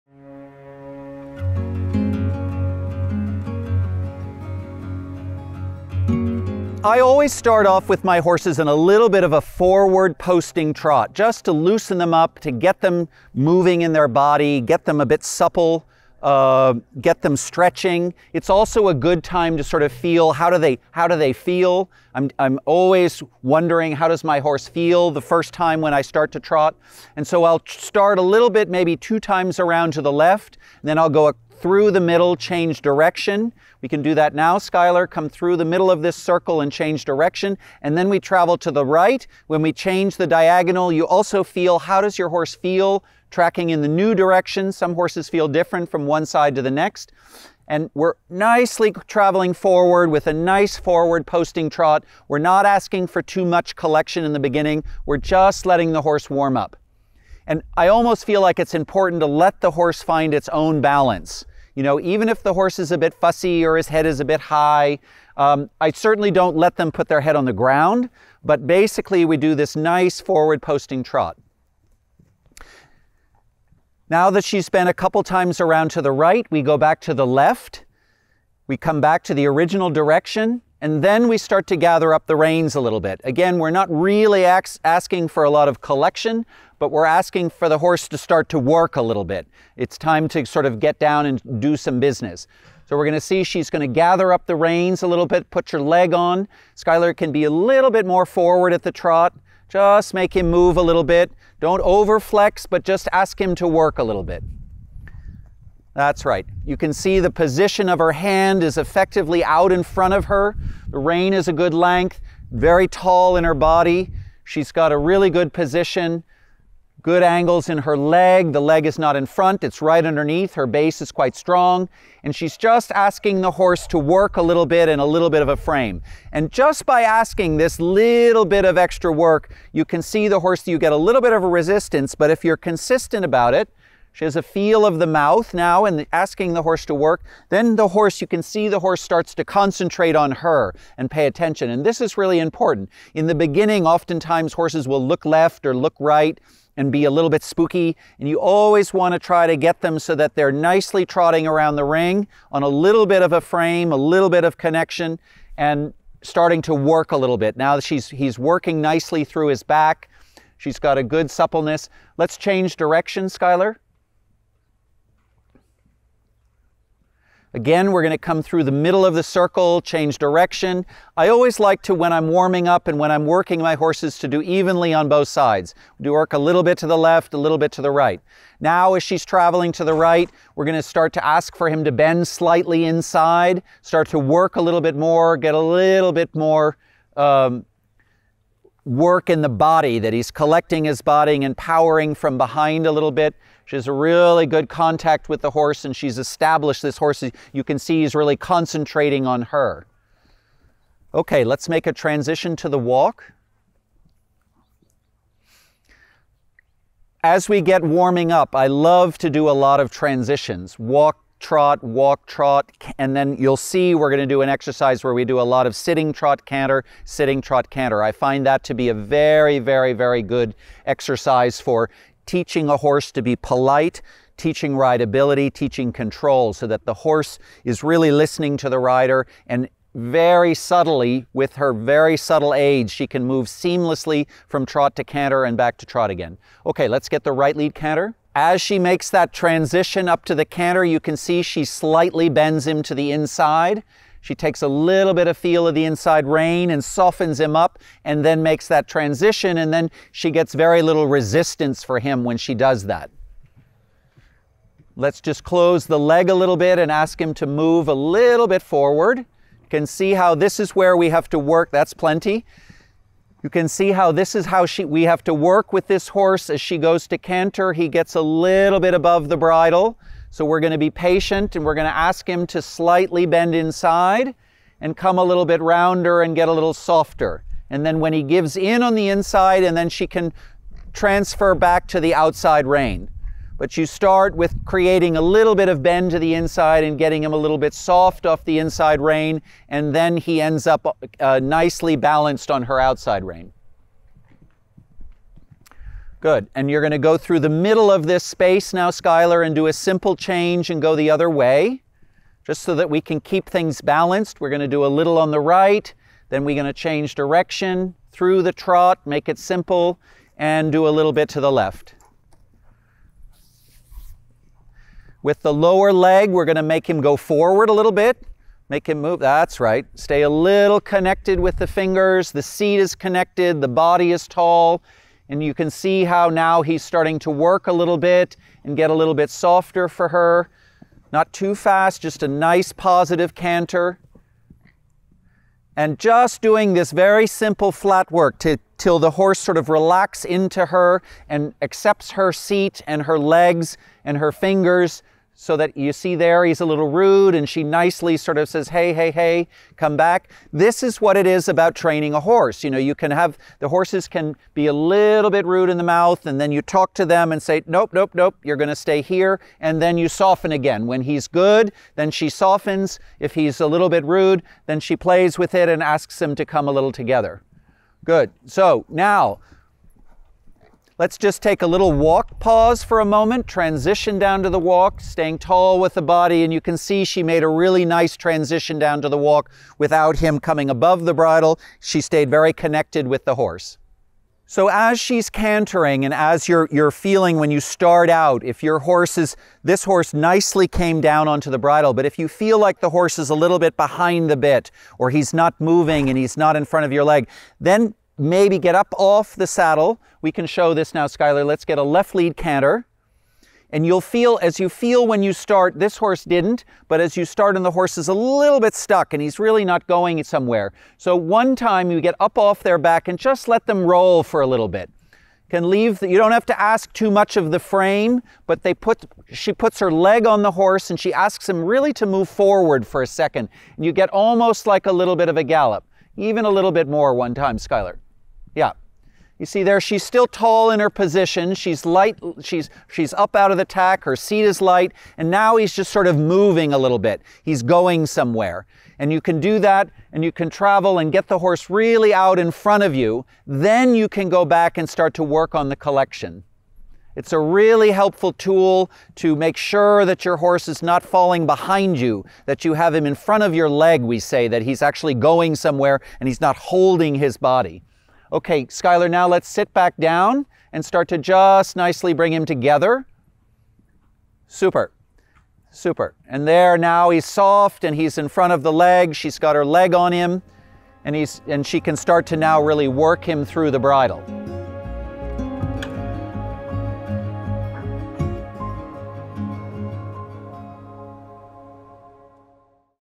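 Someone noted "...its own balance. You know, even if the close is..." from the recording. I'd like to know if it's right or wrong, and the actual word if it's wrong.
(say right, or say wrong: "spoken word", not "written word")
wrong: "horse", not "close".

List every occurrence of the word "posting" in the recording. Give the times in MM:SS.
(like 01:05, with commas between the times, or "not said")
00:10, 00:51, 01:10.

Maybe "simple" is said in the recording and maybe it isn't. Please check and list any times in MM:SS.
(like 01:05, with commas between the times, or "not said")
04:59, 05:09, 05:37.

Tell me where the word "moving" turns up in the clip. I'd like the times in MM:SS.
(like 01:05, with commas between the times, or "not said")
00:13, 06:35, 07:16.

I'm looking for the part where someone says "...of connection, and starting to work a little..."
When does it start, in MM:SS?
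02:34.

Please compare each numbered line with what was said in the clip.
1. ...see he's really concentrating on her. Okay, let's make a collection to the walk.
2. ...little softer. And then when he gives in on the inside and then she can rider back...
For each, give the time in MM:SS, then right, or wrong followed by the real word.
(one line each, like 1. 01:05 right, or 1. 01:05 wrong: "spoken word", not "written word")
1. 03:17 wrong: "transition", not "collection"
2. 04:36 wrong: "transfer", not "rider".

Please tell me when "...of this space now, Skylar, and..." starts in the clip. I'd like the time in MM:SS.
04:57.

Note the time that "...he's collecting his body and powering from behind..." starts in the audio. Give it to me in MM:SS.
03:10.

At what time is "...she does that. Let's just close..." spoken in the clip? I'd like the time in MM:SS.
04:12.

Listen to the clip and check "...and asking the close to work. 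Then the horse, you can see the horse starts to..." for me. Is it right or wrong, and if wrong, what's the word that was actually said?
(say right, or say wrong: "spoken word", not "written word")
wrong: "horse", not "close".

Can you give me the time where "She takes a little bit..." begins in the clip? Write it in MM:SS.
04:04.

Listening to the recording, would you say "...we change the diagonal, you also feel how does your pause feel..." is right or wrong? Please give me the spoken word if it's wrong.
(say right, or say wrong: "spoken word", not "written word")
wrong: "horse", not "pause".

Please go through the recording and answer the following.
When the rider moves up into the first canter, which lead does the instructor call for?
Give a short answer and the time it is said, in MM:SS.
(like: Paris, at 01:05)
right lead, at 03:57.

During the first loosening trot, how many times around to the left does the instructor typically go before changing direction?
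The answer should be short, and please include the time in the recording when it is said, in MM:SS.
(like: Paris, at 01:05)
2, at 00:28.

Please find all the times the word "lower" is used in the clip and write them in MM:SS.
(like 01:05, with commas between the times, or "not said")
05:15.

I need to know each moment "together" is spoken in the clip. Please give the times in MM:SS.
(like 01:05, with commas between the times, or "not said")
06:06, 07:42.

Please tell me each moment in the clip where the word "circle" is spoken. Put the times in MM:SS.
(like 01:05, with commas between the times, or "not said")
00:36, 02:49.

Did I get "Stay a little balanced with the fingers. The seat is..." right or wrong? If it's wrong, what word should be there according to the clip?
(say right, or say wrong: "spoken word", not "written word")
wrong: "connected", not "balanced".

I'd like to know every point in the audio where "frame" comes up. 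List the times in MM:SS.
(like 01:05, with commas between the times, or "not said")
02:05, 02:33, 06:57.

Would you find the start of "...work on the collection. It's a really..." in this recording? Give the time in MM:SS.
07:25.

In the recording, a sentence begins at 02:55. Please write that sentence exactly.
Do work a little bit to the left, a little bit to the right.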